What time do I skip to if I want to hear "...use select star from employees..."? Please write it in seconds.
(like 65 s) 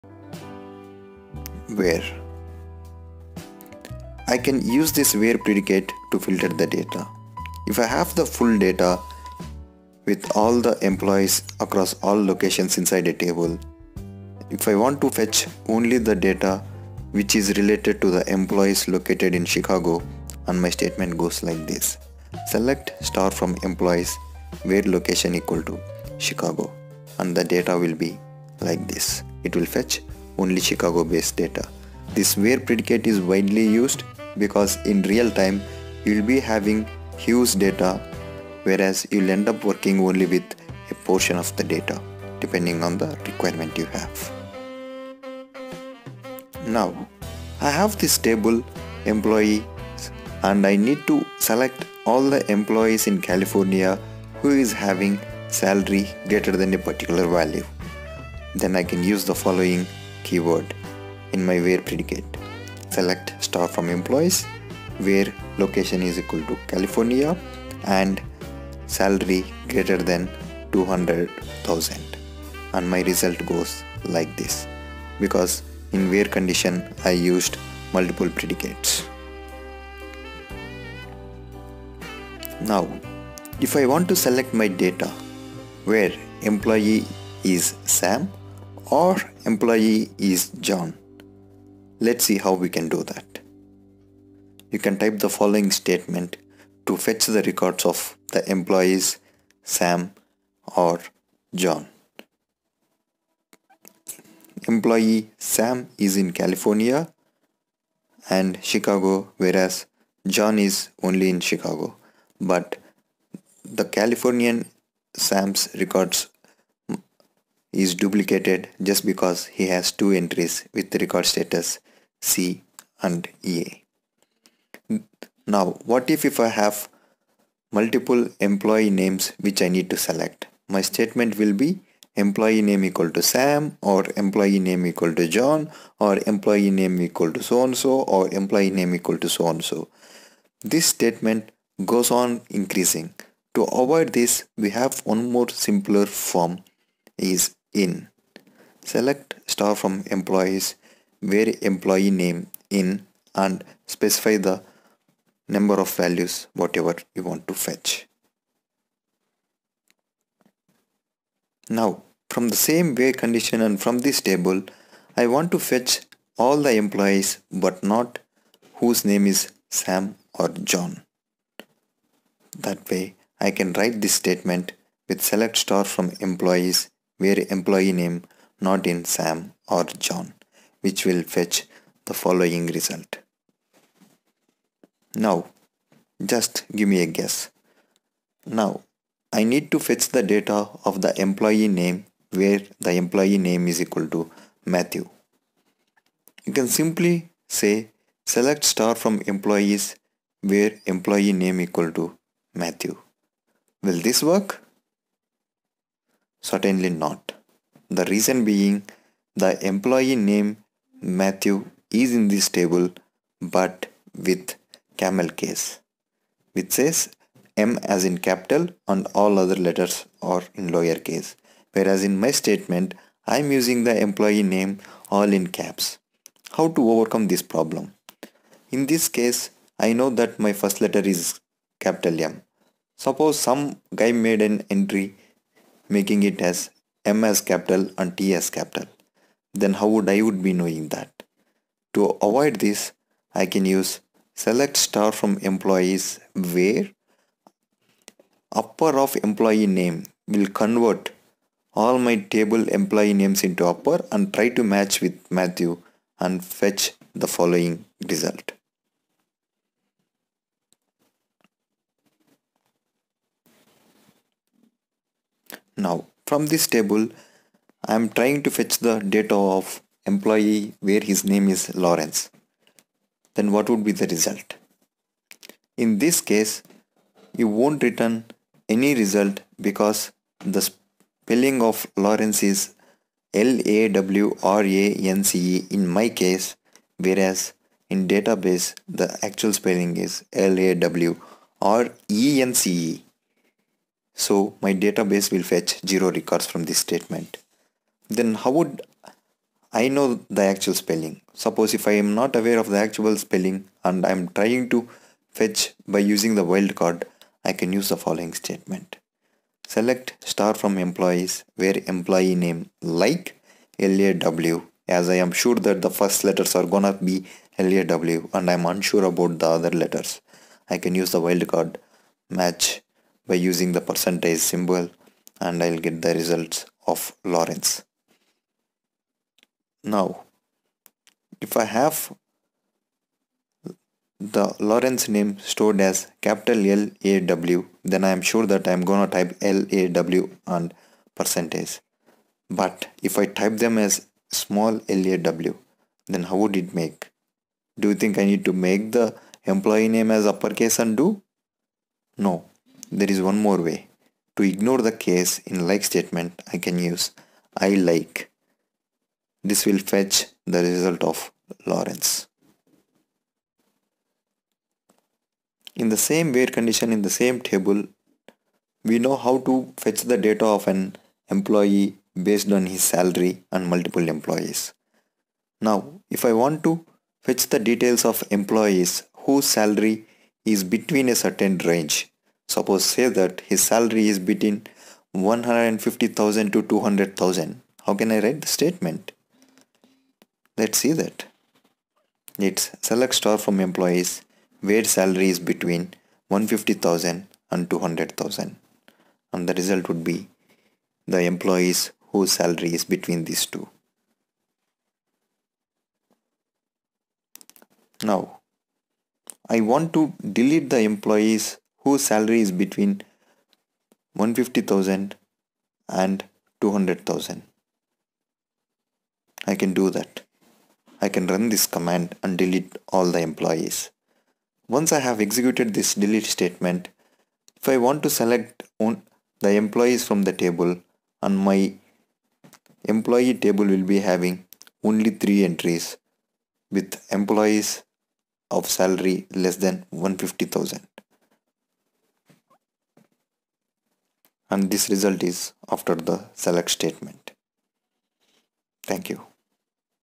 243 s.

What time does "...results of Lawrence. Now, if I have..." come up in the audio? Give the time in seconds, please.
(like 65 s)
326 s.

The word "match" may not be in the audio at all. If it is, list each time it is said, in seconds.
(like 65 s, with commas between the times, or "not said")
254 s, 322 s.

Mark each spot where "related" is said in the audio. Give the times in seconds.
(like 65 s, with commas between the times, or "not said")
17 s.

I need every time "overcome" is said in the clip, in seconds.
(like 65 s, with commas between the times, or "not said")
226 s.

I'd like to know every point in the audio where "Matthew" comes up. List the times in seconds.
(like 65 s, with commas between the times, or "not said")
194 s, 202 s, 211 s, 255 s.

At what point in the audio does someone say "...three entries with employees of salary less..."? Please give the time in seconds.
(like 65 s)
435 s.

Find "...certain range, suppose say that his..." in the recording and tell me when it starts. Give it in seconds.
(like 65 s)
381 s.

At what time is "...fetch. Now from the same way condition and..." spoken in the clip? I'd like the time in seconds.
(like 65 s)
157 s.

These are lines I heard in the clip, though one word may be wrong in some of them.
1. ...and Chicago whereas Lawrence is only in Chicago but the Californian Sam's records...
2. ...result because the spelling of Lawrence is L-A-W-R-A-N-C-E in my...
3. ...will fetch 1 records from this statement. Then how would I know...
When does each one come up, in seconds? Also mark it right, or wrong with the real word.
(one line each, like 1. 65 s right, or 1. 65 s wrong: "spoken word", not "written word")
1. 108 s wrong: "John", not "Lawrence"
2. 279 s right
3. 295 s wrong: "0", not "1".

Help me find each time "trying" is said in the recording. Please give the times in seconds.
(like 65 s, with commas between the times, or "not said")
268 s, 304 s.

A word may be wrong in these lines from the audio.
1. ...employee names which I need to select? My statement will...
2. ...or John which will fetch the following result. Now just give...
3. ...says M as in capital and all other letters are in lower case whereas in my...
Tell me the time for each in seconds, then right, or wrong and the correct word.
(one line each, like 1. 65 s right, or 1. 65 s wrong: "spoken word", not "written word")
1. 128 s right
2. 179 s right
3. 216 s right.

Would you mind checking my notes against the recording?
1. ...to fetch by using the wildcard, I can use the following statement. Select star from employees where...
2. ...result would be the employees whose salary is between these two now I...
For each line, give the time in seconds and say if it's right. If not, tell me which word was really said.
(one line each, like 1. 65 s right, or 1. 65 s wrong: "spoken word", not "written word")
1. 304 s right
2. 399 s right.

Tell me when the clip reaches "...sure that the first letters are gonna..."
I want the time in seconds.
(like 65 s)
315 s.